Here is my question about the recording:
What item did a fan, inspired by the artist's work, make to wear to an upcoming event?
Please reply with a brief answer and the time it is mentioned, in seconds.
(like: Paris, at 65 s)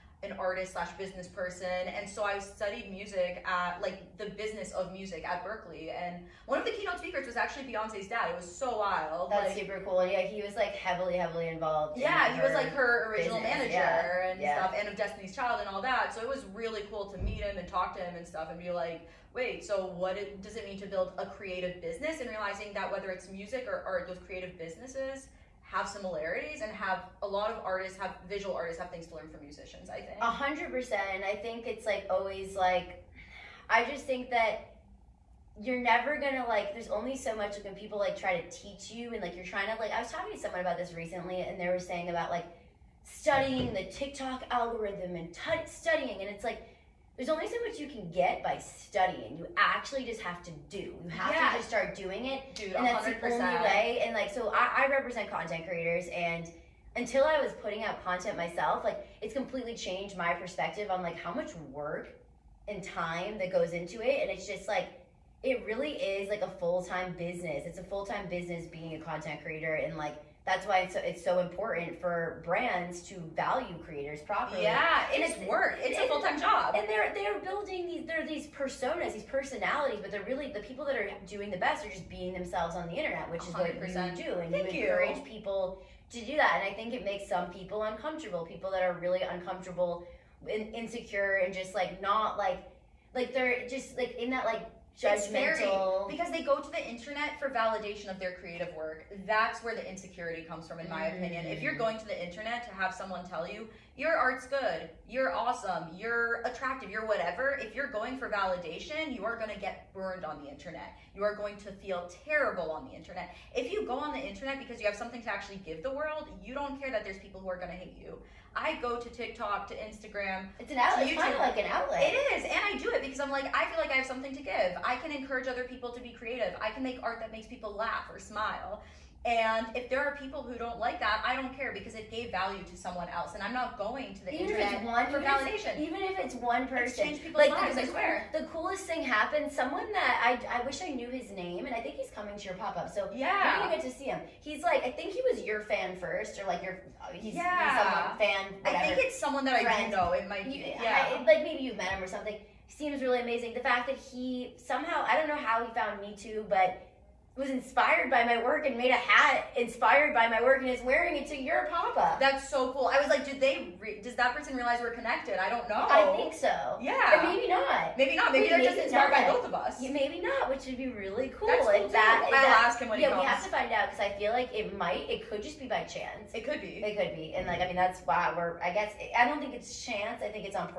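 a hat, at 158 s.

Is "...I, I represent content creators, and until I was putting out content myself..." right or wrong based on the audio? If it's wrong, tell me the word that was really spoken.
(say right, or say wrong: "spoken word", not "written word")
right.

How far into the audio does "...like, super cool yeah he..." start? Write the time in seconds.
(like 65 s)
9 s.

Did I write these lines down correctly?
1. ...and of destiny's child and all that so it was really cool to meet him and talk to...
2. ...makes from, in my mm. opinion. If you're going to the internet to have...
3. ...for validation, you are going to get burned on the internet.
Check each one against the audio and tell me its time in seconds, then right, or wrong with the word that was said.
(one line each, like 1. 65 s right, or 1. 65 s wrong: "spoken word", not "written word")
1. 14 s right
2. 100 s wrong: "comes", not "makes"
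3. 108 s right.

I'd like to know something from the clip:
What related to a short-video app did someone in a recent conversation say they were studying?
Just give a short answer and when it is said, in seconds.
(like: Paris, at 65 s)
TikTok algorithm, at 43 s.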